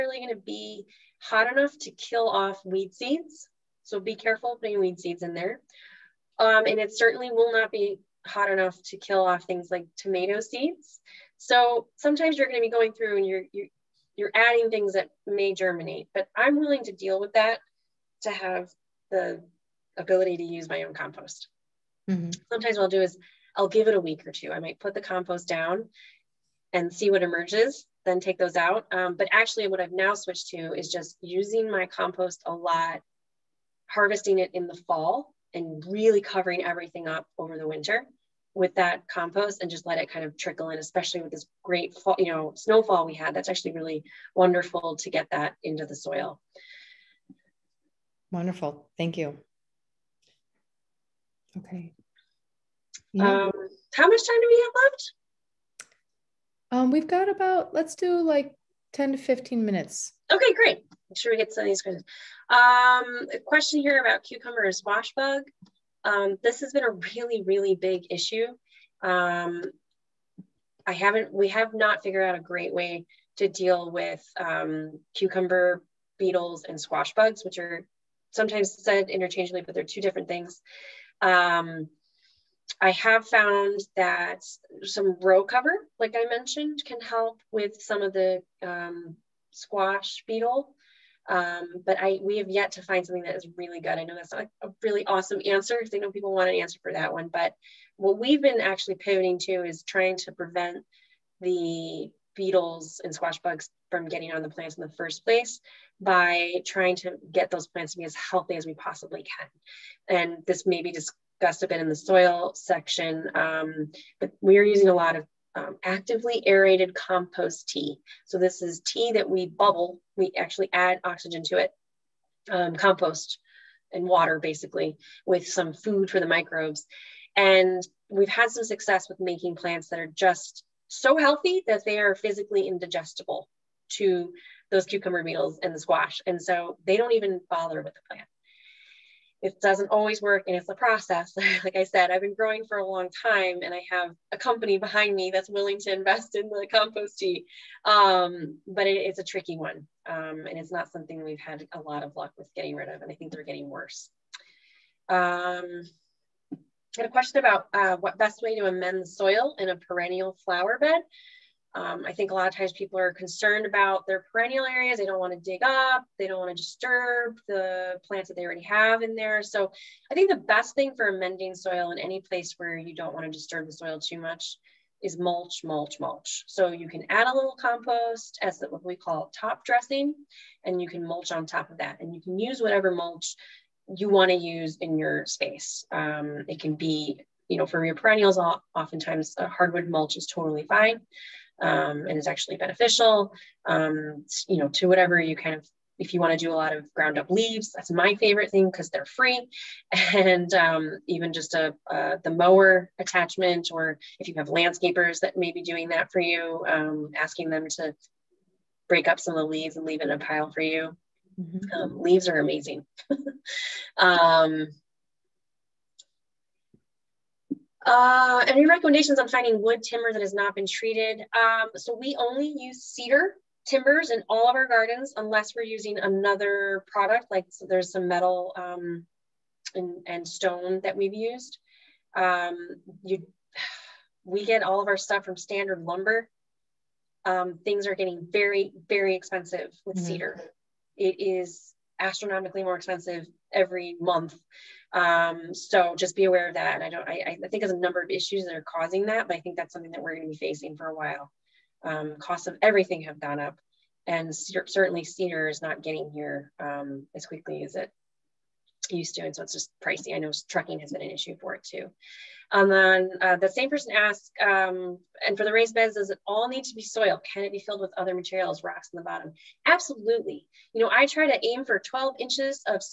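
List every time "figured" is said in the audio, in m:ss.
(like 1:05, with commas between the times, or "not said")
1:12.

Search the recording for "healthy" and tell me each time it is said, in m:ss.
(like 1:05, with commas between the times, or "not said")
1:48, 2:11.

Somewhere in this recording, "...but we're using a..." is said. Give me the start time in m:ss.
1:54.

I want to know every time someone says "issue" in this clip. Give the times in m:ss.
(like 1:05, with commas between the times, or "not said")
1:08, 4:08, 4:21.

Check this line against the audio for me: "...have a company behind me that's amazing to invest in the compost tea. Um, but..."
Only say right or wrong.
wrong.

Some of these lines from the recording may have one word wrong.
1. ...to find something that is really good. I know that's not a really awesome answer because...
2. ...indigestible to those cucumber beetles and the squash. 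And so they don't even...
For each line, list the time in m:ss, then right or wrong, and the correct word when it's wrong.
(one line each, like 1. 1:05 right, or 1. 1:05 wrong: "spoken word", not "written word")
1. 1:32 right
2. 2:12 right.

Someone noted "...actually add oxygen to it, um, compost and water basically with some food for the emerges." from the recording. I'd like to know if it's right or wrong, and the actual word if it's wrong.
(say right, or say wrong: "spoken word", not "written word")
wrong: "microbes", not "emerges".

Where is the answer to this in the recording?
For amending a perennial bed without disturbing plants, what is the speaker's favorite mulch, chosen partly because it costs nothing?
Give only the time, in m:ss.
3:16.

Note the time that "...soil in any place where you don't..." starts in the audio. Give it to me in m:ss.
2:51.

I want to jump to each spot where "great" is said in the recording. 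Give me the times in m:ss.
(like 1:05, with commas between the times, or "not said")
0:41, 1:00, 1:12.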